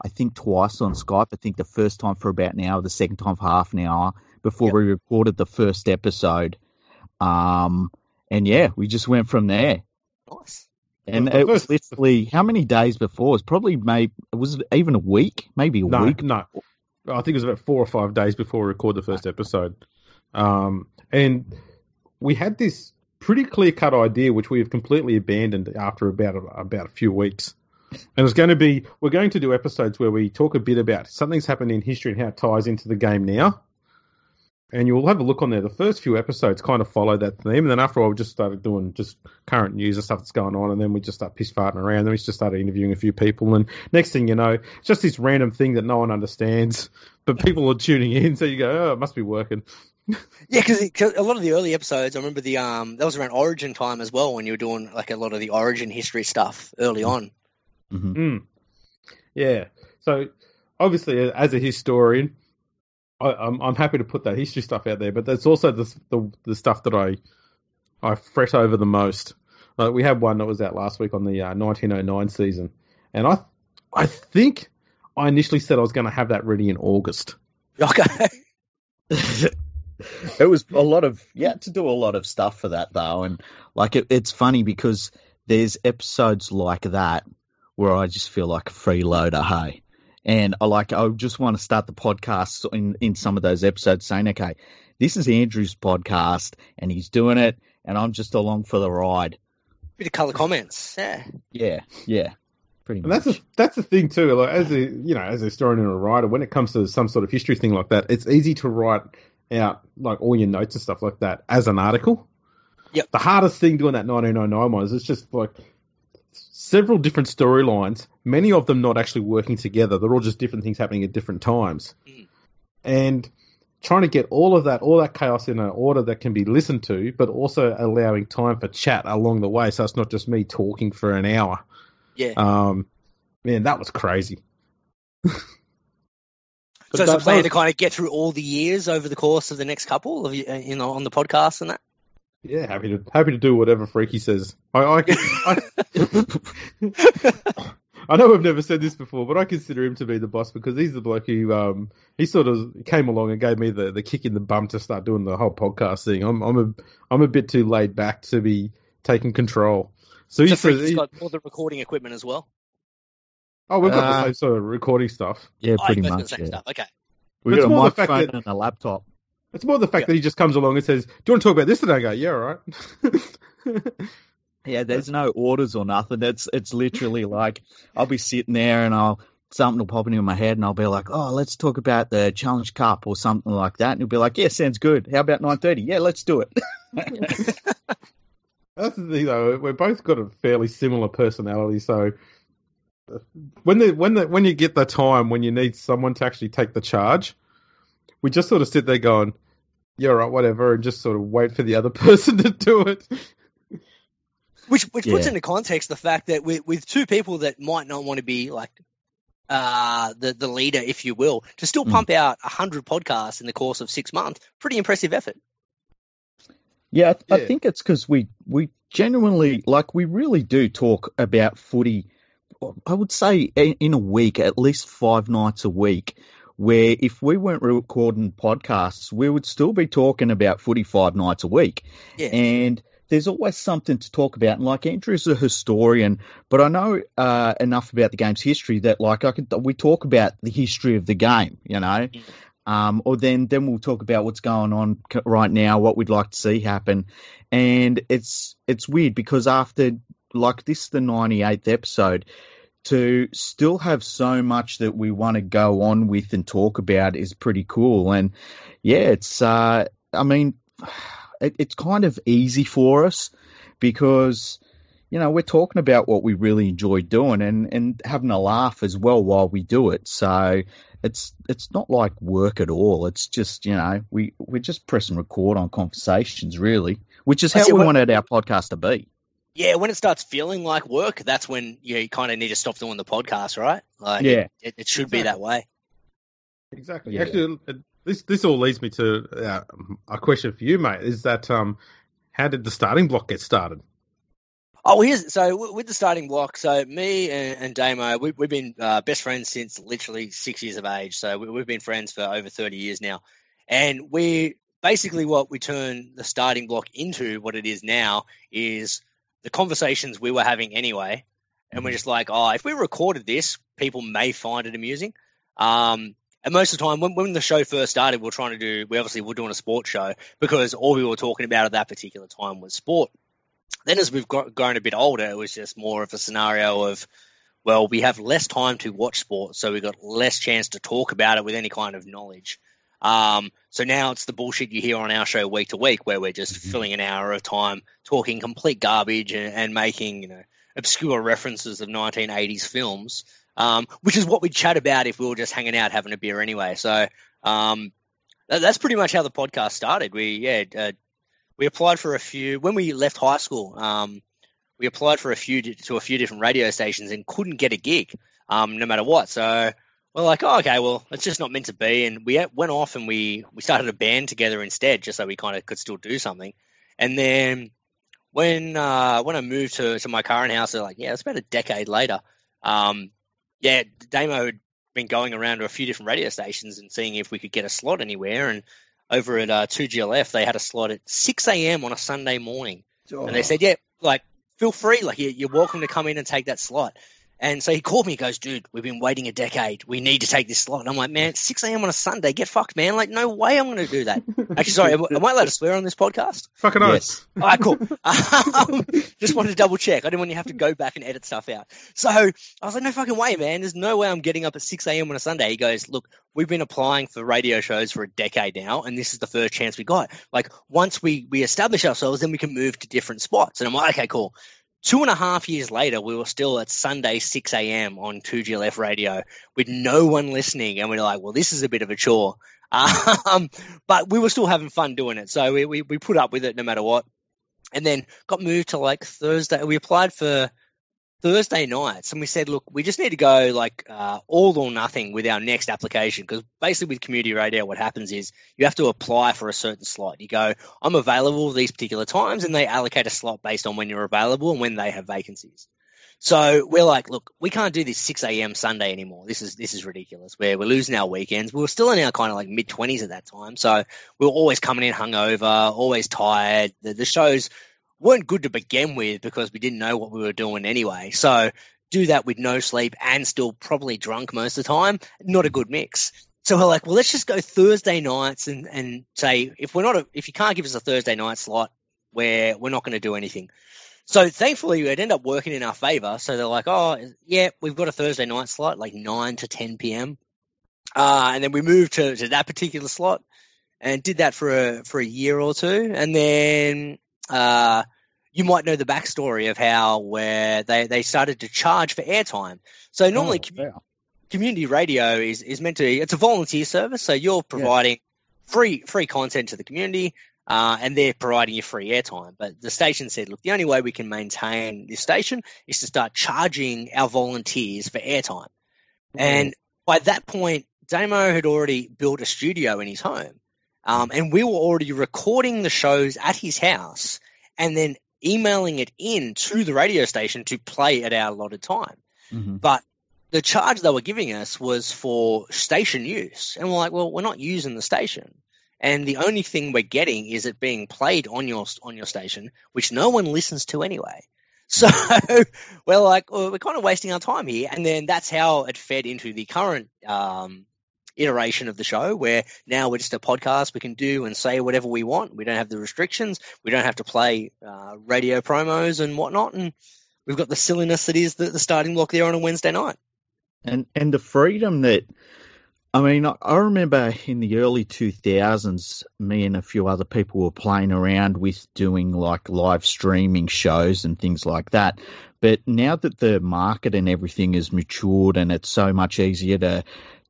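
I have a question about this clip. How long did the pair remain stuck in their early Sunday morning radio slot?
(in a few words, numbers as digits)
Two and a half years.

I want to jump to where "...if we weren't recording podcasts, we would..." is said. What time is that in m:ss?
3:46.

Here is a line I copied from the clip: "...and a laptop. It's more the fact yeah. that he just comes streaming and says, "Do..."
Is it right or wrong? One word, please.
wrong.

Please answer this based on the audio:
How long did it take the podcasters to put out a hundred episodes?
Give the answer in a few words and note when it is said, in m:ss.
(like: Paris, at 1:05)
6 months, at 3:33.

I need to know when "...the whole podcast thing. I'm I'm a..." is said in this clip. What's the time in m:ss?
2:35.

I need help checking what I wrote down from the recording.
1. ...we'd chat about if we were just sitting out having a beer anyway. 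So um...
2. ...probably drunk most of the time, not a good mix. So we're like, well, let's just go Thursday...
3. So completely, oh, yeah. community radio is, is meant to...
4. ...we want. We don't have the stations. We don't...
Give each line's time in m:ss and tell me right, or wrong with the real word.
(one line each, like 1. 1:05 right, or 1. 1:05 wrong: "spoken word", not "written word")
1. 5:44 wrong: "hanging", not "sitting"
2. 7:43 right
3. 8:12 wrong: "normally", not "completely"
4. 9:04 wrong: "restrictions", not "stations".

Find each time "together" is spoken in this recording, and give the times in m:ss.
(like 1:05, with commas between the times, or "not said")
1:59, 6:04.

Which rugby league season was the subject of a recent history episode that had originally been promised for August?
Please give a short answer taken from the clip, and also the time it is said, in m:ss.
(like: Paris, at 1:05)
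1909, at 1:11.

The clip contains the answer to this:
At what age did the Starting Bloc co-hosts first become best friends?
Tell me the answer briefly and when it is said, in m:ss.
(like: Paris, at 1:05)
6, at 5:00.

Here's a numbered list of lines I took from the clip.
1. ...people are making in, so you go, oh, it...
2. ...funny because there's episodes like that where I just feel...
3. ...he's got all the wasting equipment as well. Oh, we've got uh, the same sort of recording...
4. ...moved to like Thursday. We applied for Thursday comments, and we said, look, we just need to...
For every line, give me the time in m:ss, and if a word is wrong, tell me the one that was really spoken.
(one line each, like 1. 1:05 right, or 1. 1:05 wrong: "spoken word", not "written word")
1. 0:47 wrong: "tuning", not "making"
2. 1:24 right
3. 2:40 wrong: "recording", not "wasting"
4. 7:08 wrong: "nights", not "comments".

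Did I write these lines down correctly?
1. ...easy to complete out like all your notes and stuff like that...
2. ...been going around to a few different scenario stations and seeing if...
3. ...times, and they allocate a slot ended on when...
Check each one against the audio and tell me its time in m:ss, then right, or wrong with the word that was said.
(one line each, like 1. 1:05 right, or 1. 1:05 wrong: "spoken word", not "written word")
1. 1:48 wrong: "write", not "complete"
2. 6:14 wrong: "radio", not "scenario"
3. 7:22 wrong: "based", not "ended".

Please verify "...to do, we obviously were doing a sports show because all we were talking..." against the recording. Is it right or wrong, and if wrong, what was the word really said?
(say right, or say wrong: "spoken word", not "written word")
right.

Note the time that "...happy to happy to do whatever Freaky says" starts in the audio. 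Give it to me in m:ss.
2:22.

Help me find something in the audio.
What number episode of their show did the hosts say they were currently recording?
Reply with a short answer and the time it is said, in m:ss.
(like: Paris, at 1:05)
98th, at 4:10.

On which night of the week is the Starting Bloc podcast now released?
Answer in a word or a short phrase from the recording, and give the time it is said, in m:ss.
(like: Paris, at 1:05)
Wednesday, at 9:12.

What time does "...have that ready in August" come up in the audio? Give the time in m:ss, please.
1:16.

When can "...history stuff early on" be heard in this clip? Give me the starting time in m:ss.
0:55.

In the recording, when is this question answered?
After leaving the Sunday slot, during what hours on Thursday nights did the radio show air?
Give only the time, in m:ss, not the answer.
7:58.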